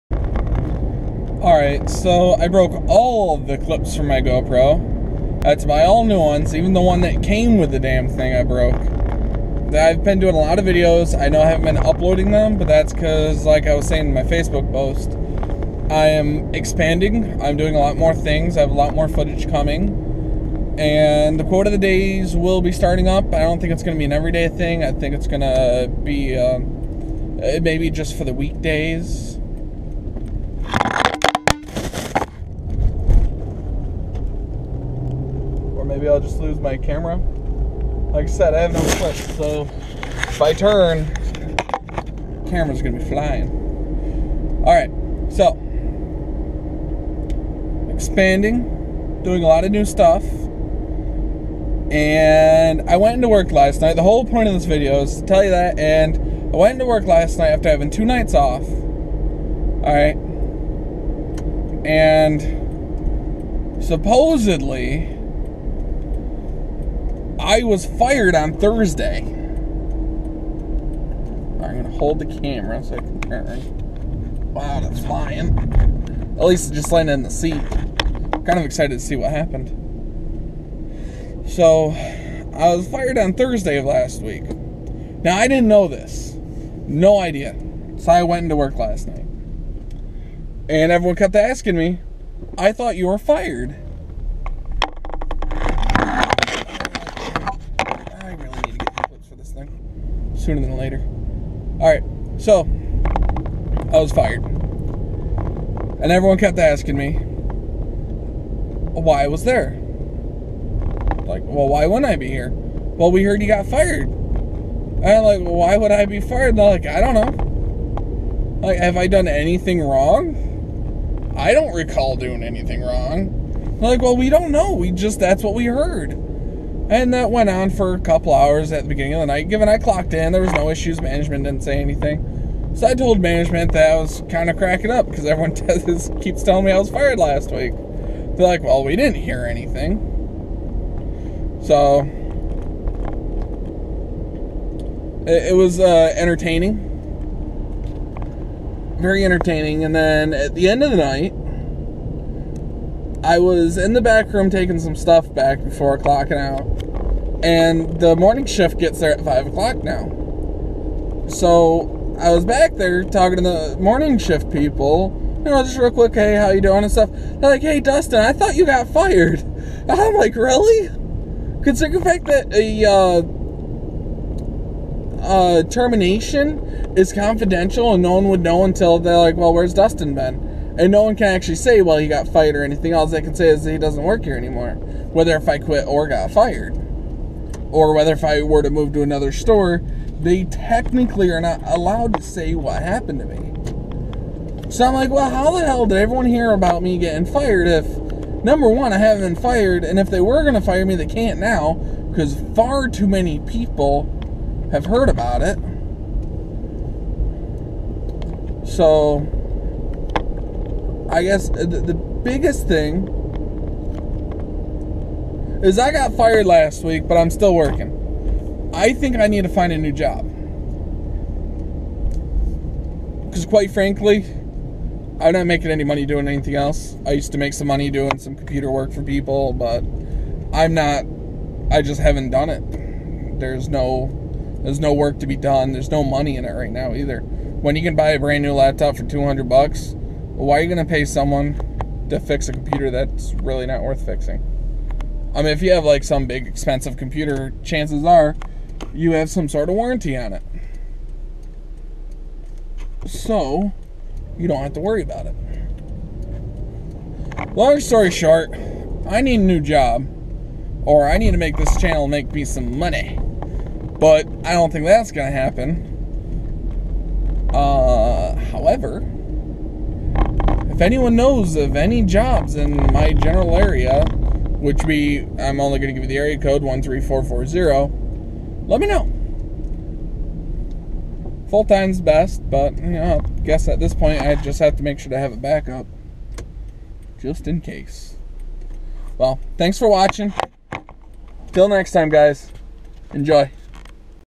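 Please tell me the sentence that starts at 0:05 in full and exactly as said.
That's my all new ones, even the one that came with the damn thing I broke.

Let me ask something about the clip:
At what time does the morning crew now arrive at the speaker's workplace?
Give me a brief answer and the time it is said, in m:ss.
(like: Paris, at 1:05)
5 o'clock, at 2:39.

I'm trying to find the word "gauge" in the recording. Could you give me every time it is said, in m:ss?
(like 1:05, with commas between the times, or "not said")
not said.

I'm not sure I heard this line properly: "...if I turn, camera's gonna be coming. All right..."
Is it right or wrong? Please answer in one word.
wrong.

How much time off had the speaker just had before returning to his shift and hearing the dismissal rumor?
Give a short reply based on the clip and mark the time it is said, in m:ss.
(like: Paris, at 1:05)
2 nights off, at 0:57.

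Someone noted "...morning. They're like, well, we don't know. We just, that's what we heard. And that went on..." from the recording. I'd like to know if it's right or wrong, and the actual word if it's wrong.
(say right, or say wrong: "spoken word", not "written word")
wrong: "wrong", not "morning".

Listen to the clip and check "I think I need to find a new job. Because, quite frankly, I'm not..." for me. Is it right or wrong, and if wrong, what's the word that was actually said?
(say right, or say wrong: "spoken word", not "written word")
right.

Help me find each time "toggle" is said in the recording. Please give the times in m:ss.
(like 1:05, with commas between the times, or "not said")
not said.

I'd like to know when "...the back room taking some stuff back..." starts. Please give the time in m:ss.
2:33.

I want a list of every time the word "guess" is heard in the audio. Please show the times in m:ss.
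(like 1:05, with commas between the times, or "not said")
3:31, 4:43.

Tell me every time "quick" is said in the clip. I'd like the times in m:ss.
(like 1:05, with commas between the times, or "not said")
2:45.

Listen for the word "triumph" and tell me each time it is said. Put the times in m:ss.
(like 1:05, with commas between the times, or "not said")
not said.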